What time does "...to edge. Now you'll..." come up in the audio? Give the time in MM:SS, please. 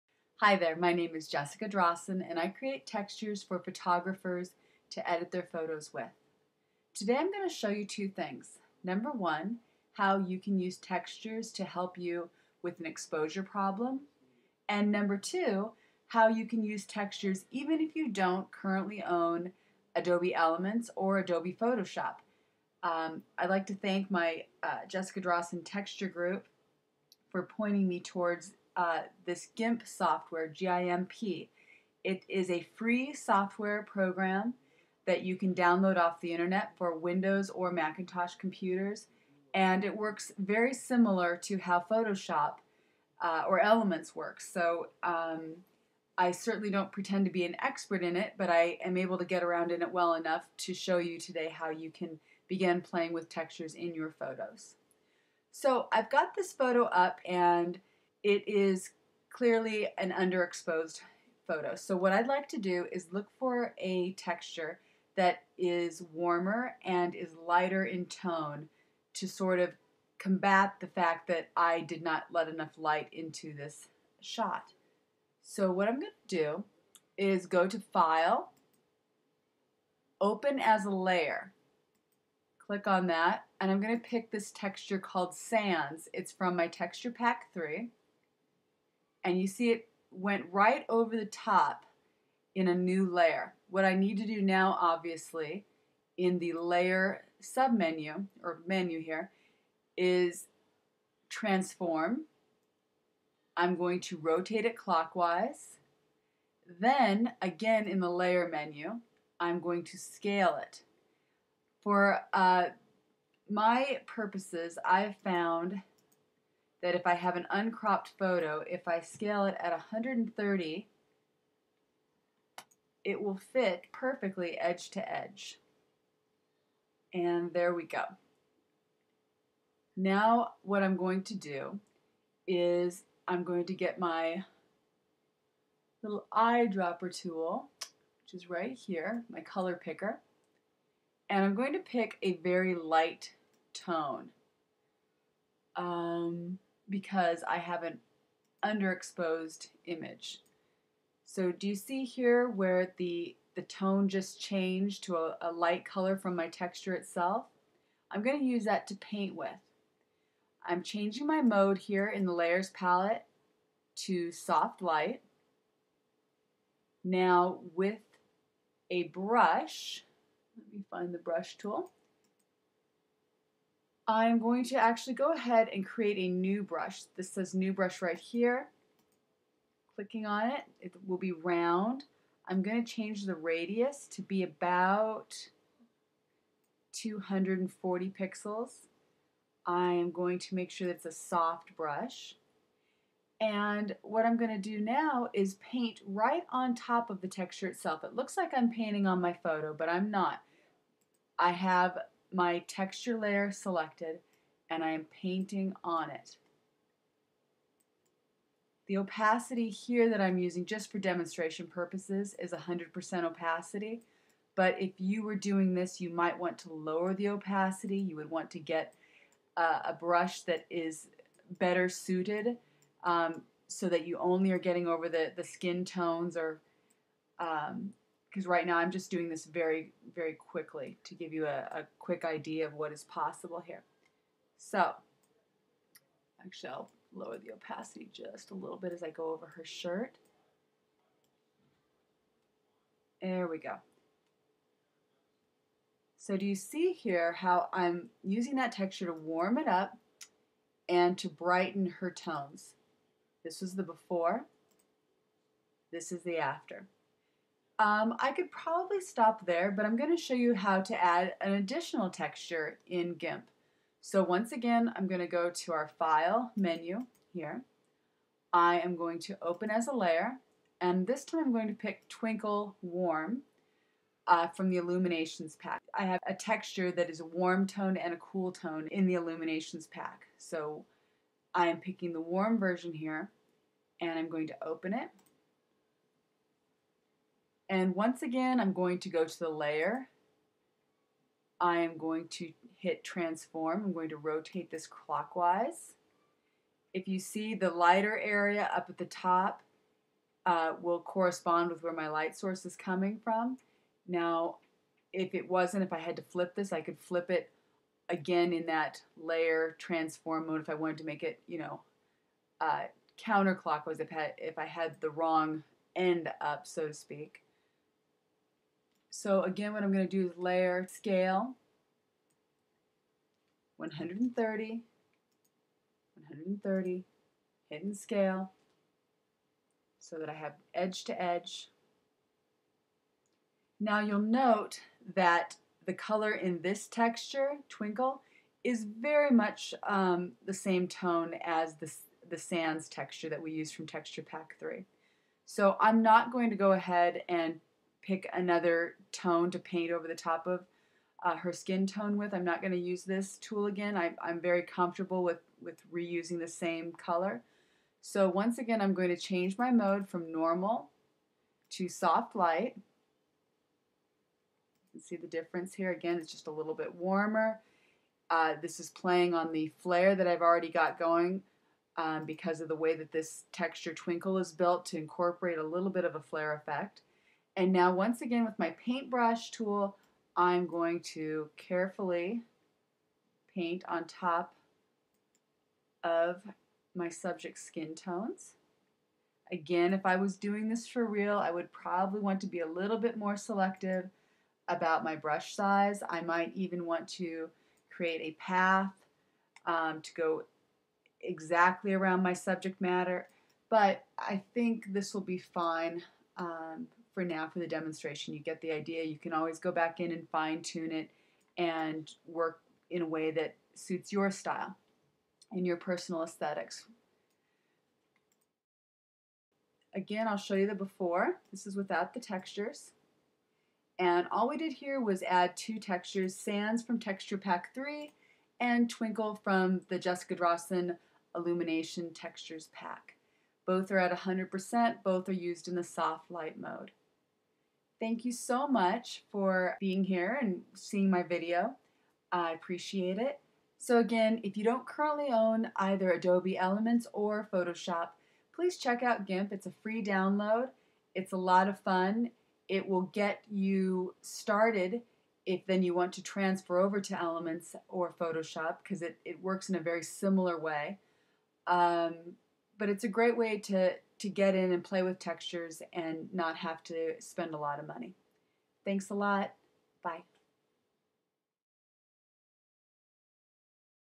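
05:31.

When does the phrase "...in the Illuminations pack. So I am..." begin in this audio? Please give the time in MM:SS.
04:38.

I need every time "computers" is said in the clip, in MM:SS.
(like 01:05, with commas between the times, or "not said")
00:38.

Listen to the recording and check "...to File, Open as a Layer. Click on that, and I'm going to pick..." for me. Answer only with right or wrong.
right.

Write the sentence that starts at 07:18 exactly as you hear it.
Thank you so much for being here and seeing my video.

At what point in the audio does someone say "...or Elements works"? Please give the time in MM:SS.
00:43.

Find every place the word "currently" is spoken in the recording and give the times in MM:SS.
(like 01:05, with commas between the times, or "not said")
00:18, 07:24.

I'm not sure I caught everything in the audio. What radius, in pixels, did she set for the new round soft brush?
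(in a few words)
240.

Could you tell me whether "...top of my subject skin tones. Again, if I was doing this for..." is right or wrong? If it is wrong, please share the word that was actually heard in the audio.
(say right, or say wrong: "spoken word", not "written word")
right.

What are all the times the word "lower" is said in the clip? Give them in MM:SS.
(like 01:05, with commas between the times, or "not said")
03:36, 03:57.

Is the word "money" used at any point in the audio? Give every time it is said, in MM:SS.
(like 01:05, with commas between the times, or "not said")
07:47.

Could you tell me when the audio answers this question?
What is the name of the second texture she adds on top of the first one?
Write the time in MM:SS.
04:32.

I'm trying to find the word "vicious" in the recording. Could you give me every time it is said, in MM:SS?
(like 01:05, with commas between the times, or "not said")
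not said.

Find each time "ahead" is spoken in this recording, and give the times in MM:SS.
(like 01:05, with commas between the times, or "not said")
02:55, 05:46.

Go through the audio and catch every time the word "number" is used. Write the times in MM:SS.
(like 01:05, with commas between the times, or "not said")
00:08, 00:14.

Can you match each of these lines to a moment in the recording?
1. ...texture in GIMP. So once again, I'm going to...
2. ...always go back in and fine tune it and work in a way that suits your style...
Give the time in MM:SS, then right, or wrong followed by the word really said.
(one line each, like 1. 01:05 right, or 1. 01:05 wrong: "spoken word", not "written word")
1. 04:22 right
2. 06:49 right.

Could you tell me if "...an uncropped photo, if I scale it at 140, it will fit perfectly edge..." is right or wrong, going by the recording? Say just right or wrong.
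wrong.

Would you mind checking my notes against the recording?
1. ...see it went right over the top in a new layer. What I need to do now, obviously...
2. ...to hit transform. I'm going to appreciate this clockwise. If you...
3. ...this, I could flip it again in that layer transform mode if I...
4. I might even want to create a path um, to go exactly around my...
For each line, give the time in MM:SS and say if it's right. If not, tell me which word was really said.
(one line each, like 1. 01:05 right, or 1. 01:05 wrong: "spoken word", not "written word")
1. 01:29 right
2. 04:52 wrong: "rotate", not "appreciate"
3. 05:06 right
4. 06:36 right.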